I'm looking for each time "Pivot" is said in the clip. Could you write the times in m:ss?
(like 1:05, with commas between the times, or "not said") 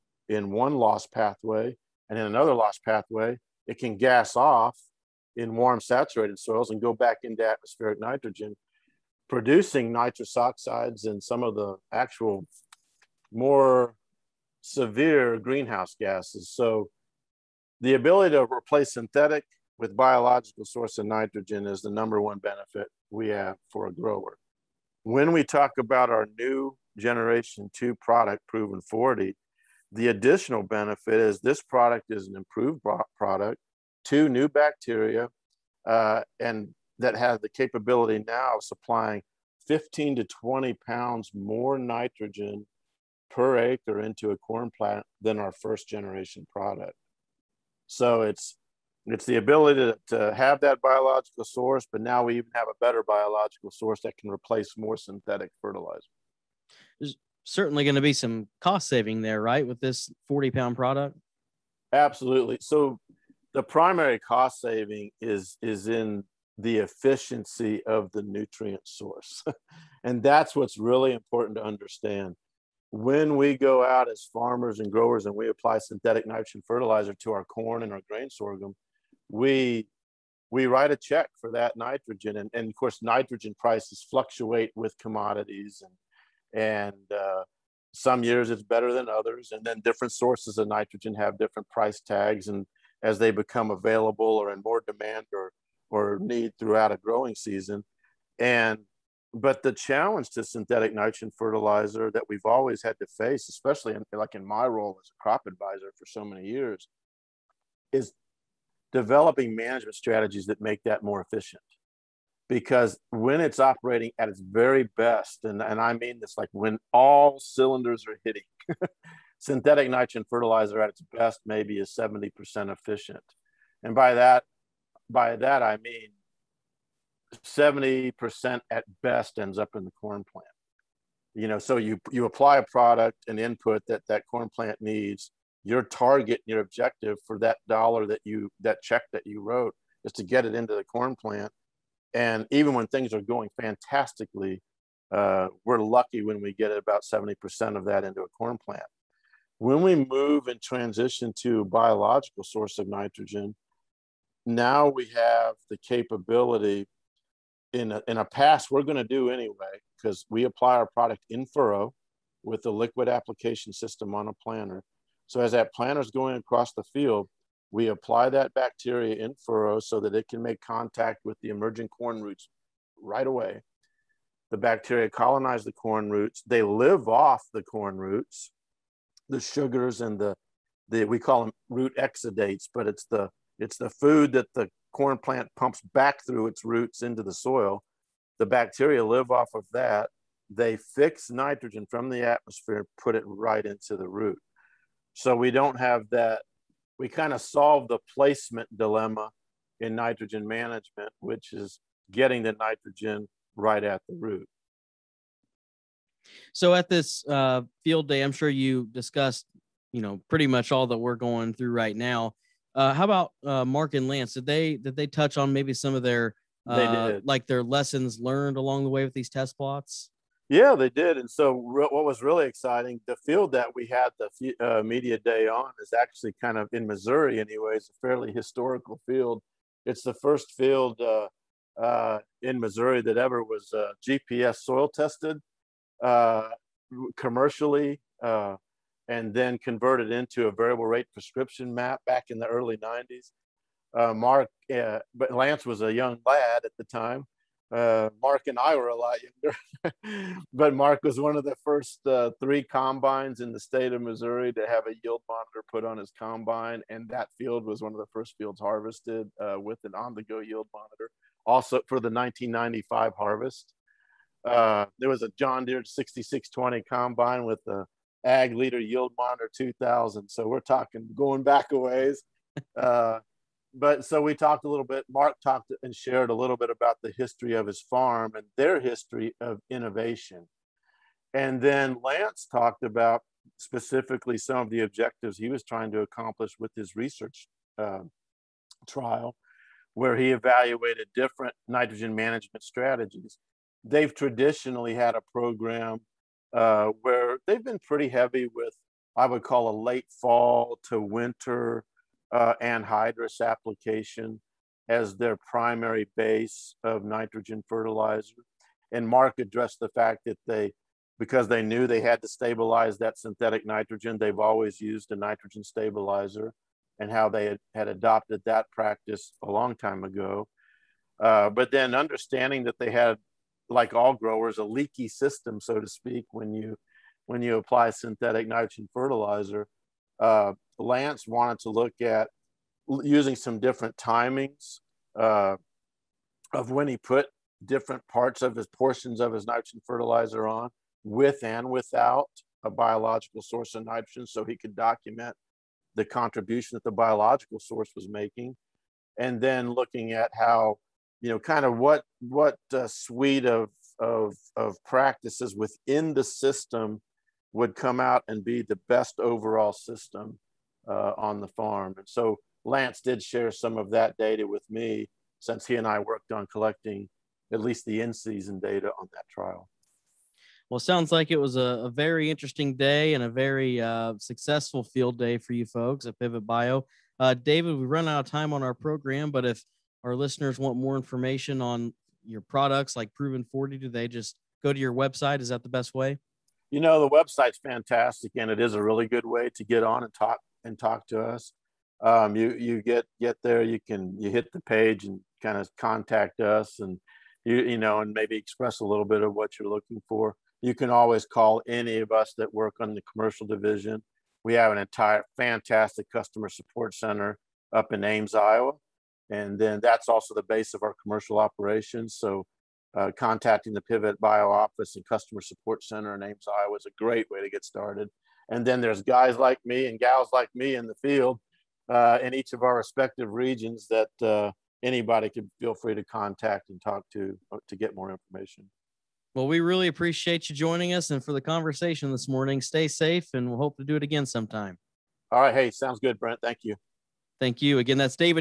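6:16, 6:53.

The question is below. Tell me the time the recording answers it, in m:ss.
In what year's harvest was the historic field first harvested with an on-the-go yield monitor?
4:22.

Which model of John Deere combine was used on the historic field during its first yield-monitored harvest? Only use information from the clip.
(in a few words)
6620.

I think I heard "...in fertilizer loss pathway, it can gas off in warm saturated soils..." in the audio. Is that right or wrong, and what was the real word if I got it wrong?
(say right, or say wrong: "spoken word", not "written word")
wrong: "another", not "fertilizer".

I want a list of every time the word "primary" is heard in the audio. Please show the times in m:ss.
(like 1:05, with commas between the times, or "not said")
1:03, 5:05.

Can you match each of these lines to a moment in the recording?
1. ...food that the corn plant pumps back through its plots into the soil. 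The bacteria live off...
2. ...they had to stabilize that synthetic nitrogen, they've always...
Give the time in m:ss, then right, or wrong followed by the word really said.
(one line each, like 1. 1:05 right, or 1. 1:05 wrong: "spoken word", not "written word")
1. 3:03 wrong: "roots", not "plots"
2. 5:11 right.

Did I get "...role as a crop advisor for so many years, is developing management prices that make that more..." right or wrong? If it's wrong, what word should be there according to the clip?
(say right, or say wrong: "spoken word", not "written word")
wrong: "strategies", not "prices".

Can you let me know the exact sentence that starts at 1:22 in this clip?
And, and of course, nitrogen prices fluctuate with commodities and and uh, some years it's better than others.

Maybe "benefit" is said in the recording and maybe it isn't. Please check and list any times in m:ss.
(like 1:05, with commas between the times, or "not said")
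0:22, 0:30.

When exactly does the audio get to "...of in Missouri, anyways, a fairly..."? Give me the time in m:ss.
3:46.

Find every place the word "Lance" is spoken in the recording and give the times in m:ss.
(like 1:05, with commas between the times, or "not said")
3:34, 4:05, 4:42, 5:30, 6:02.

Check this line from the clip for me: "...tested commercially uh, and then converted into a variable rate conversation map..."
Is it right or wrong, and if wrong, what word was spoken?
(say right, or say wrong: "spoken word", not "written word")
wrong: "prescription", not "conversation".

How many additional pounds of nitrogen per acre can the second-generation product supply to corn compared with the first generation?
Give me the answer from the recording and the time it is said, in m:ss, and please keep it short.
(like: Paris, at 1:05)
15 to 20, at 0:39.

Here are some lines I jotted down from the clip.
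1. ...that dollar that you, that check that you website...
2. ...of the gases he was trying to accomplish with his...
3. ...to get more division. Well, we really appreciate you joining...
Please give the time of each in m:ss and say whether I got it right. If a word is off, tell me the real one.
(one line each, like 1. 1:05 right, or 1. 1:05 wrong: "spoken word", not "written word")
1. 2:17 wrong: "wrote", not "website"
2. 4:44 wrong: "objectives", not "gases"
3. 7:07 wrong: "information", not "division".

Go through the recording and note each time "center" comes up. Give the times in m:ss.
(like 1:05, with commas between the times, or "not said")
6:46, 6:55.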